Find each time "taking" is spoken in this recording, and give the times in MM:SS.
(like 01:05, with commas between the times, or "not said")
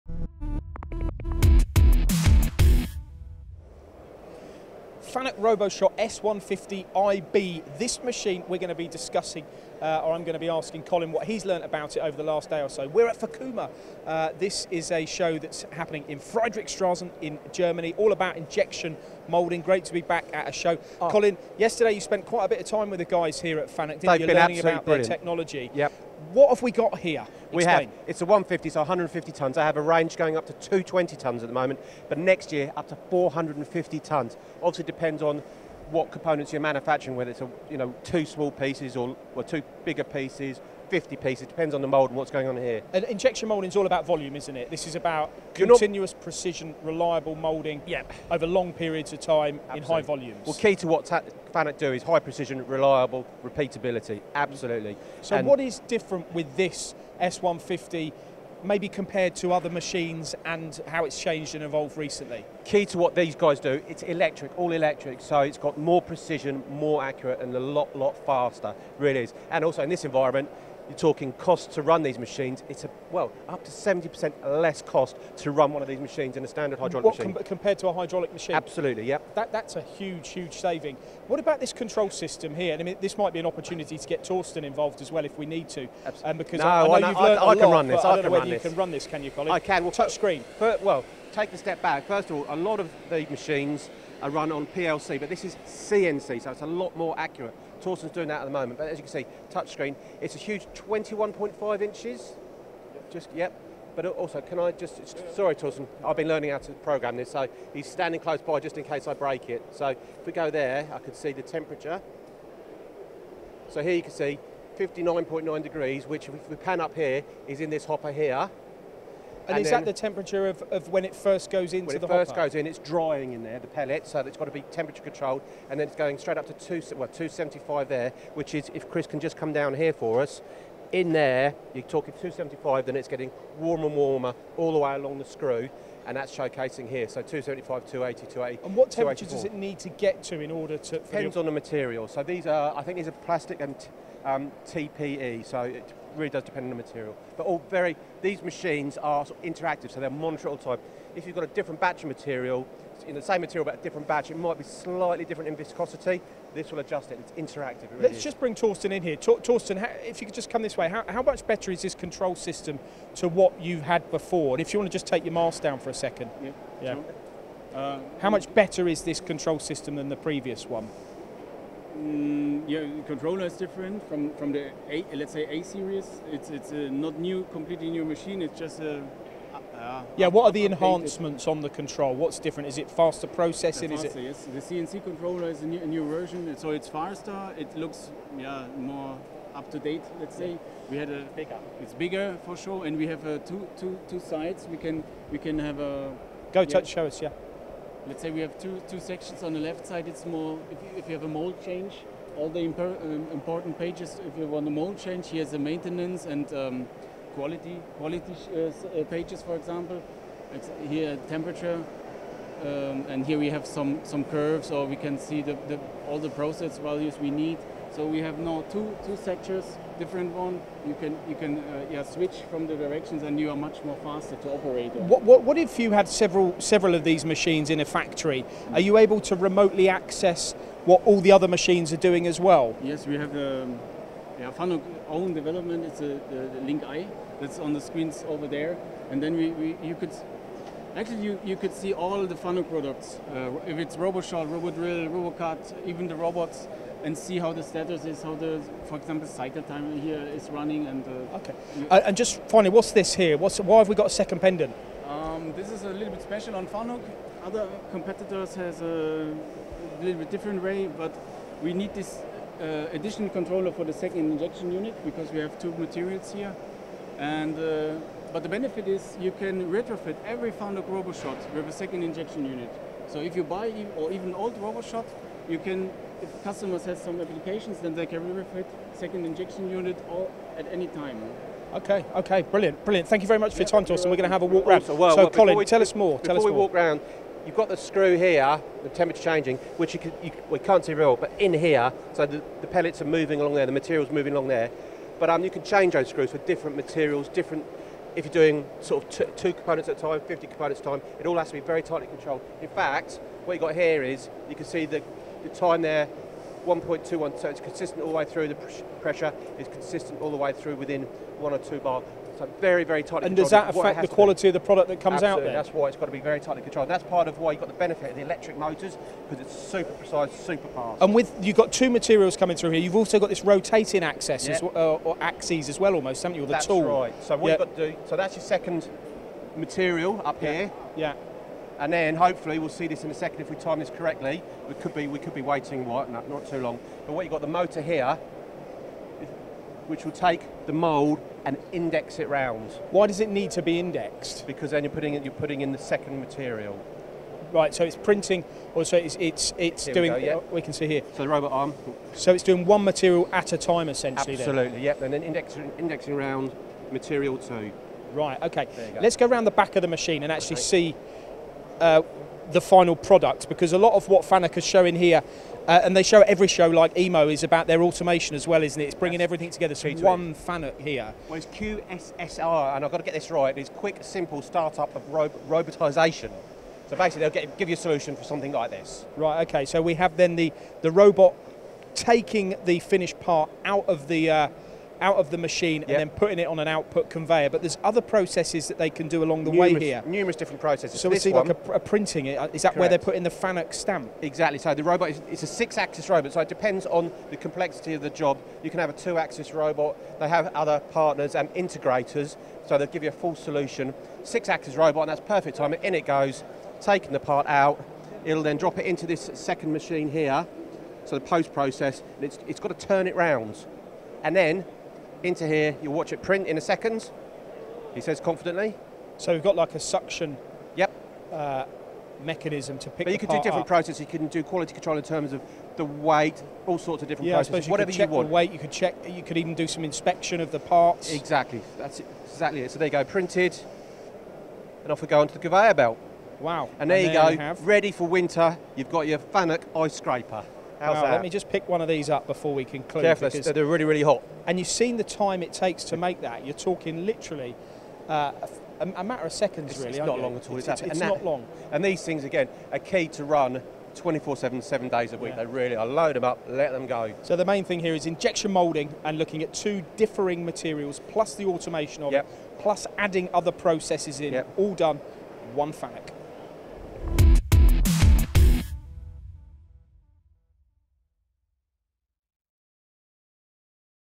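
06:21, 06:46.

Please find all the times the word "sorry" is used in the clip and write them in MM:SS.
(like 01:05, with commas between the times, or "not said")
01:45.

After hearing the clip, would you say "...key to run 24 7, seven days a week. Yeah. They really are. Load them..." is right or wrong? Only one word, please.
right.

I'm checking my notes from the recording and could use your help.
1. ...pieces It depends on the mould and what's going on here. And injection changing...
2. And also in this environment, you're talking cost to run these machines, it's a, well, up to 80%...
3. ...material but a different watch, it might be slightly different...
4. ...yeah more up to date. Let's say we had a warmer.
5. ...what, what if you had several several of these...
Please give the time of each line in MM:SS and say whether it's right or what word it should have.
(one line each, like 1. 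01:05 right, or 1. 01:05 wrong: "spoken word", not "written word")
1. 00:41 wrong: "moulding", not "changing"
2. 01:09 wrong: "70", not "80"
3. 02:33 wrong: "batch", not "watch"
4. 03:08 wrong: "bigger", not "warmer"
5. 03:45 right.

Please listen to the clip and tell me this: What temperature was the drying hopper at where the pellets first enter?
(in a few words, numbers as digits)
59.9 degrees.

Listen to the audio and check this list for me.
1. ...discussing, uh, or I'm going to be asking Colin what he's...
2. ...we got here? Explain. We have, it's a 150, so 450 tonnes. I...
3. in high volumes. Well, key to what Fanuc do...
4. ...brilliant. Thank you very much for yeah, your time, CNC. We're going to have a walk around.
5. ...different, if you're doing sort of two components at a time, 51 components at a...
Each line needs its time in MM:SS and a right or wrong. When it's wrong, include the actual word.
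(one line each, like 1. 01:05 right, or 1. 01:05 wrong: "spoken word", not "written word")
1. 00:08 right
2. 00:26 wrong: "150", not "450"
3. 00:49 right
4. 04:42 wrong: "Torsten", not "CNC"
5. 04:57 wrong: "50", not "51".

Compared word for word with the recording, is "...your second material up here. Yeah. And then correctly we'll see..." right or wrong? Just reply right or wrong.
wrong.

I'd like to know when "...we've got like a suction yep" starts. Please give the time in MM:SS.
06:59.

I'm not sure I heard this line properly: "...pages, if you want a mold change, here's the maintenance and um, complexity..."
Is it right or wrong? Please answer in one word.
wrong.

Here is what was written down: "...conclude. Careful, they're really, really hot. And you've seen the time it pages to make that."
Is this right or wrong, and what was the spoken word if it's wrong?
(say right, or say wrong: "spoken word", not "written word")
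wrong: "takes", not "pages".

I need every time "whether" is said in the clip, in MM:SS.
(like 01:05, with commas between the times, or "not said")
00:37, 01:28.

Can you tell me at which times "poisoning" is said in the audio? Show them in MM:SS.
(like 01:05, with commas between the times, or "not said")
not said.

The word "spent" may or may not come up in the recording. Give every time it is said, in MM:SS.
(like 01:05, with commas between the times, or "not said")
00:22.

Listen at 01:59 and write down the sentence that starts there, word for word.
And, and is that the temperature of, of, when it first goes into the hopper?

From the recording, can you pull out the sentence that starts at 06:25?
and then putting it on an output conveyor.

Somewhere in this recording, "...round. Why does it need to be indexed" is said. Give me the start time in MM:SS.
05:42.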